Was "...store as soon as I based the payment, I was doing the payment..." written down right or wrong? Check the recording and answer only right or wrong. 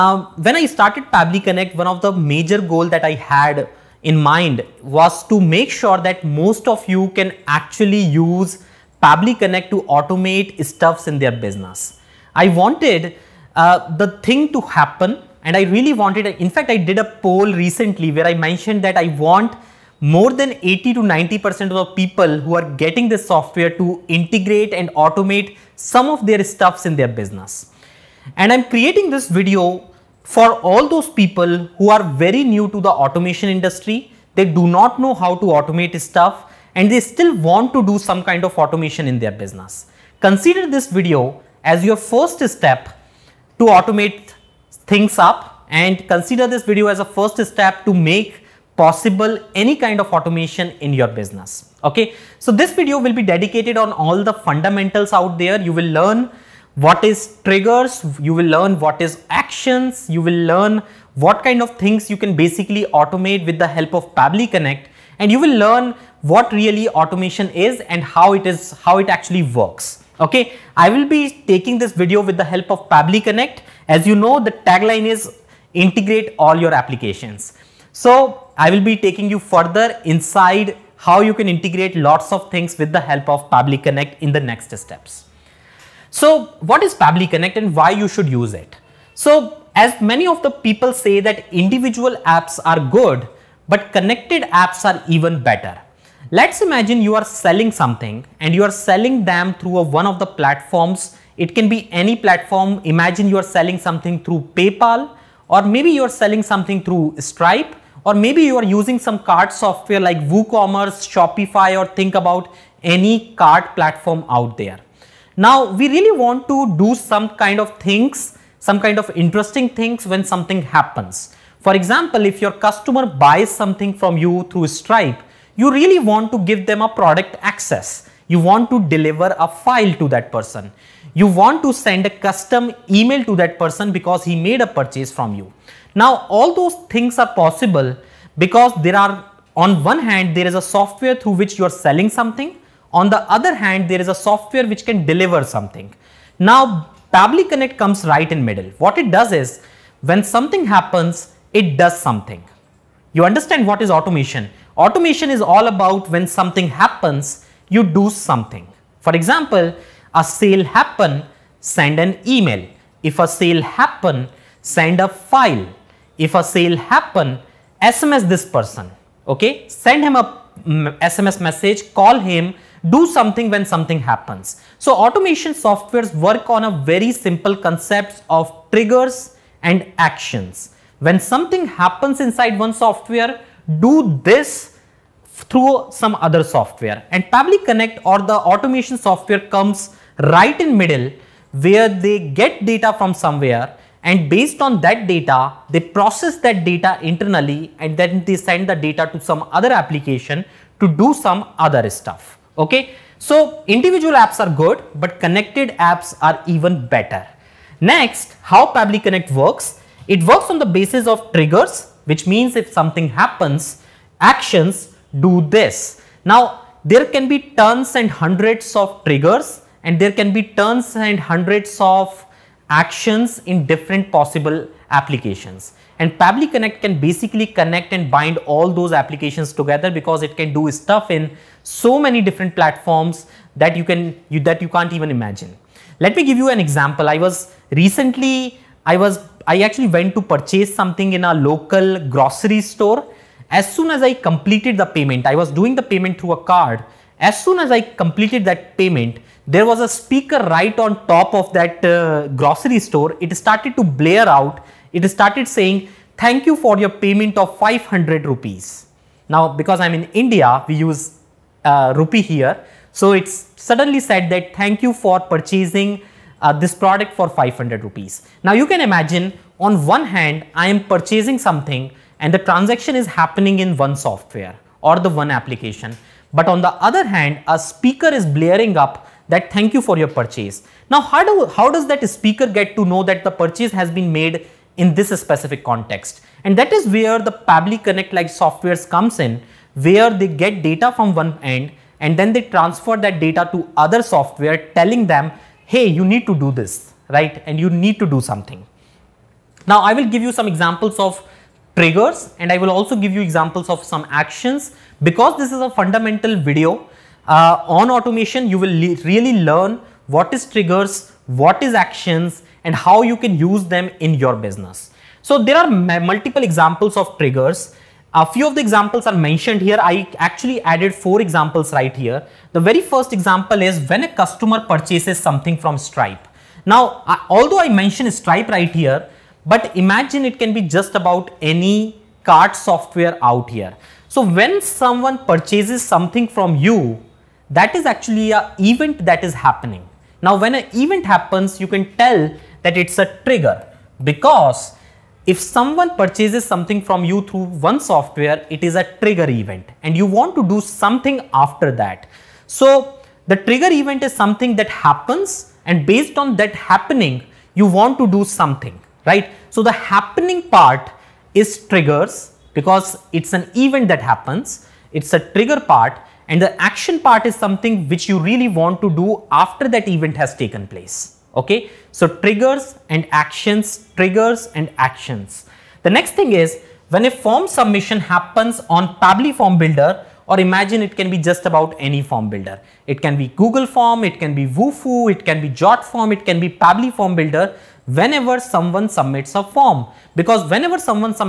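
wrong.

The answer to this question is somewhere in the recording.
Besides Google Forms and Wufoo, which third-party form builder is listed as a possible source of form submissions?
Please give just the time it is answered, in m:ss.
6:25.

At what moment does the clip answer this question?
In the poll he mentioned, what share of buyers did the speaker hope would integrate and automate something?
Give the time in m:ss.
0:20.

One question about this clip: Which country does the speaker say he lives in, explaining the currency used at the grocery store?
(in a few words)
India.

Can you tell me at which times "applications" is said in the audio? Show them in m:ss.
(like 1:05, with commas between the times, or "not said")
1:16, 3:19, 3:44, 3:48, 4:35.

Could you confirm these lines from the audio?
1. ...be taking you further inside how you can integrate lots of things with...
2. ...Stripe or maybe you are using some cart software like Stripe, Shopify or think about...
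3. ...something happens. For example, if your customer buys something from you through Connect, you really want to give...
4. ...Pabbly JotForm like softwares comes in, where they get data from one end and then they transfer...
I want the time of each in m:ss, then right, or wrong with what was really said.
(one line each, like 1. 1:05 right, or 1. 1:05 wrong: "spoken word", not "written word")
1. 1:18 right
2. 1:47 wrong: "WooCommerce", not "Stripe"
3. 2:00 wrong: "Stripe", not "Connect"
4. 4:47 wrong: "Connect", not "JotForm".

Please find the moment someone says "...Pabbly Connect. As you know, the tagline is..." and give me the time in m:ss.
1:12.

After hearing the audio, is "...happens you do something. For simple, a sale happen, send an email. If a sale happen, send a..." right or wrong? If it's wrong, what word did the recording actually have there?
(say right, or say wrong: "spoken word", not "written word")
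wrong: "example", not "simple".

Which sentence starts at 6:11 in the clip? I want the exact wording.
So triggers and actions, triggers and actions.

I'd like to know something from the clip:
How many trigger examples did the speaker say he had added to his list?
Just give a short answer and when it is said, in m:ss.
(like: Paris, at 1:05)
4, at 5:20.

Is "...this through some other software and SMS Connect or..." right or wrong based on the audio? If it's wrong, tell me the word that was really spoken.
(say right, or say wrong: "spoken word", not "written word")
wrong: "Pabbly", not "SMS".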